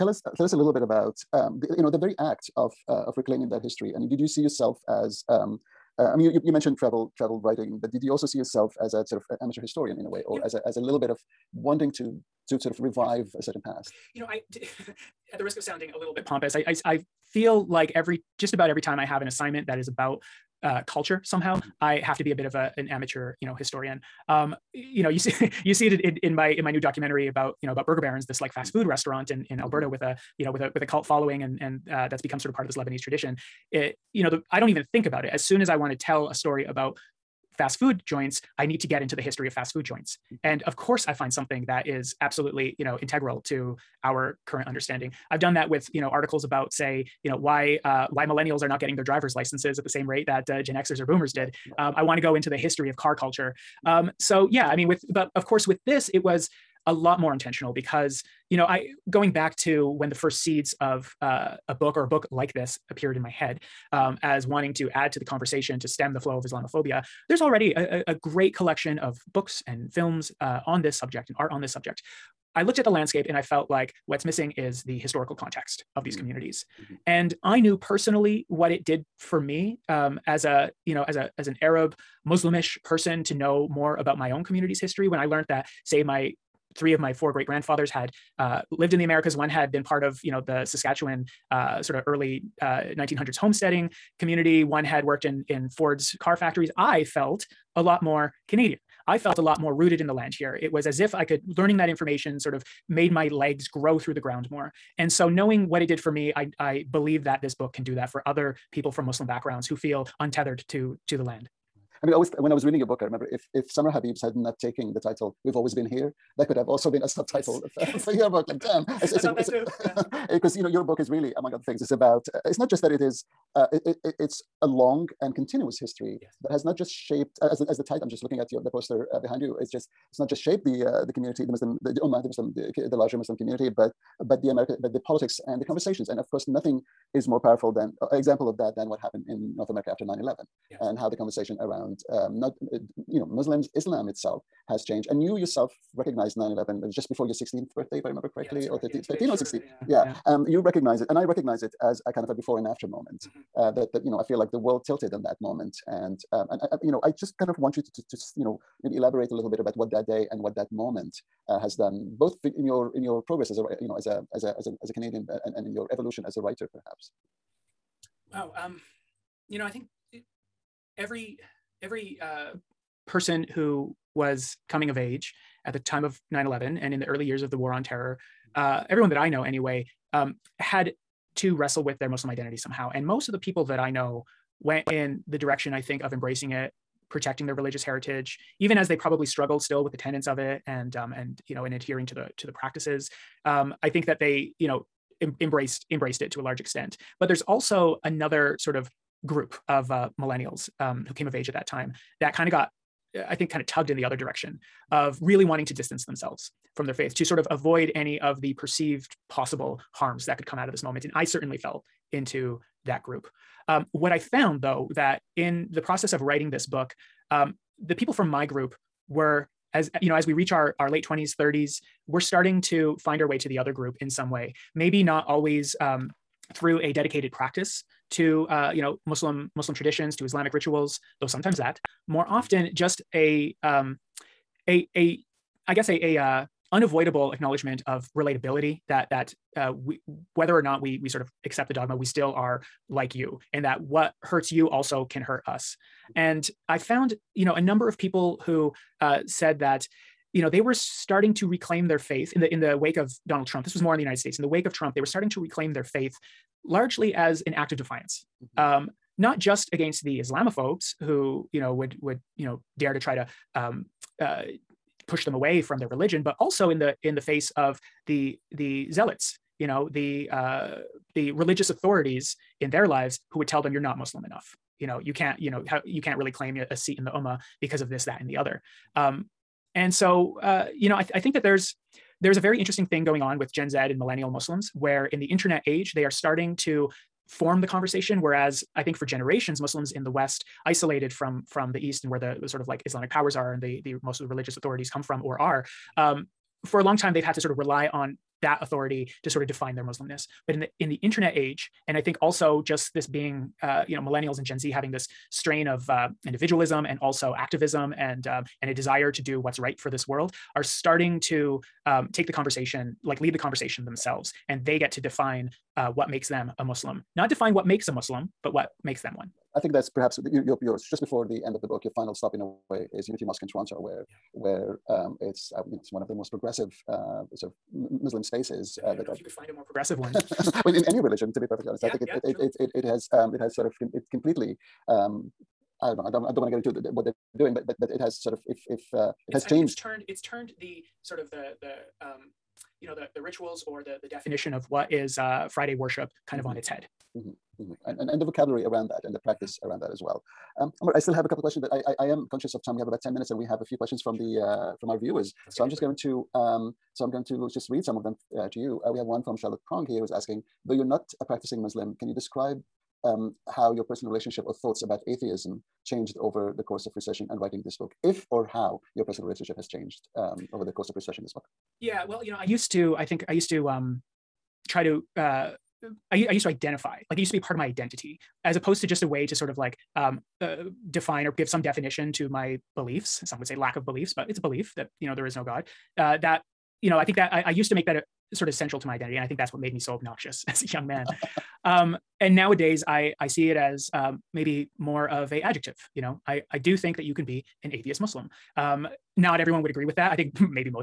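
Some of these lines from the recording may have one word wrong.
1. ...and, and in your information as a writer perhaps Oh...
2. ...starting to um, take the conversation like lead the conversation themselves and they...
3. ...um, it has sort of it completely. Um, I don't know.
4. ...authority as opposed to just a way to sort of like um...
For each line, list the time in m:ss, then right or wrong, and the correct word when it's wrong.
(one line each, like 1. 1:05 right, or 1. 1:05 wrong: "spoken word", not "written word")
1. 2:45 wrong: "evolution", not "information"
2. 5:10 right
3. 5:33 right
4. 6:17 wrong: "identity", not "authority".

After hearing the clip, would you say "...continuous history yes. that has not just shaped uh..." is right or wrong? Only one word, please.
right.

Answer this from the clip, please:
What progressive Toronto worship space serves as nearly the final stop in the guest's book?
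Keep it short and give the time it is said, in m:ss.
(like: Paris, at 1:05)
Unity Mosque, at 5:23.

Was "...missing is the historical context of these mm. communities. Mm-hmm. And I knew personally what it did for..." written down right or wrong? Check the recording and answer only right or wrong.
right.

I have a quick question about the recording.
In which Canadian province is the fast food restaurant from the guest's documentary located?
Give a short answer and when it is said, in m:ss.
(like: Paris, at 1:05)
Alberta, at 0:29.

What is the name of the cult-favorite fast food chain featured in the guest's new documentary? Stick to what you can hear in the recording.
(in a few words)
Burger Barons.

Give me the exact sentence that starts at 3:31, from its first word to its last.
And I certainly fell into that group.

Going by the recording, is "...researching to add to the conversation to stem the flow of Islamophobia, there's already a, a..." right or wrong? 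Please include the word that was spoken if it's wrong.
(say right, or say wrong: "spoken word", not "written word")
wrong: "wanting", not "researching".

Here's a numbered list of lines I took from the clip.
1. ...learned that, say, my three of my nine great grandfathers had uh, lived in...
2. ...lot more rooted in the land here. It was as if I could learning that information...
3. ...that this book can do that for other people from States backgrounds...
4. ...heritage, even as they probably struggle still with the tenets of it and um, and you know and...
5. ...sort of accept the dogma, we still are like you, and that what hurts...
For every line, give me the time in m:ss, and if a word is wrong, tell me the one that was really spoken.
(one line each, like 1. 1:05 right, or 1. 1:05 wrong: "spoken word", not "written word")
1. 1:25 wrong: "four", not "nine"
2. 1:39 right
3. 1:47 wrong: "Muslim", not "States"
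4. 3:07 right
5. 4:01 right.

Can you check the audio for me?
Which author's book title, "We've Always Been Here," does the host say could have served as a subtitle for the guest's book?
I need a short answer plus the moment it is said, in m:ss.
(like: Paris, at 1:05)
Samra Habib, at 1:53.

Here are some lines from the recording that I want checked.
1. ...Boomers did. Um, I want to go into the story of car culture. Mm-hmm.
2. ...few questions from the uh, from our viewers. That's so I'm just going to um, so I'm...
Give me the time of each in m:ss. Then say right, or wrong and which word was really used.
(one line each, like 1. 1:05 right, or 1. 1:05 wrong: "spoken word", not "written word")
1. 0:51 wrong: "history", not "story"
2. 5:53 right.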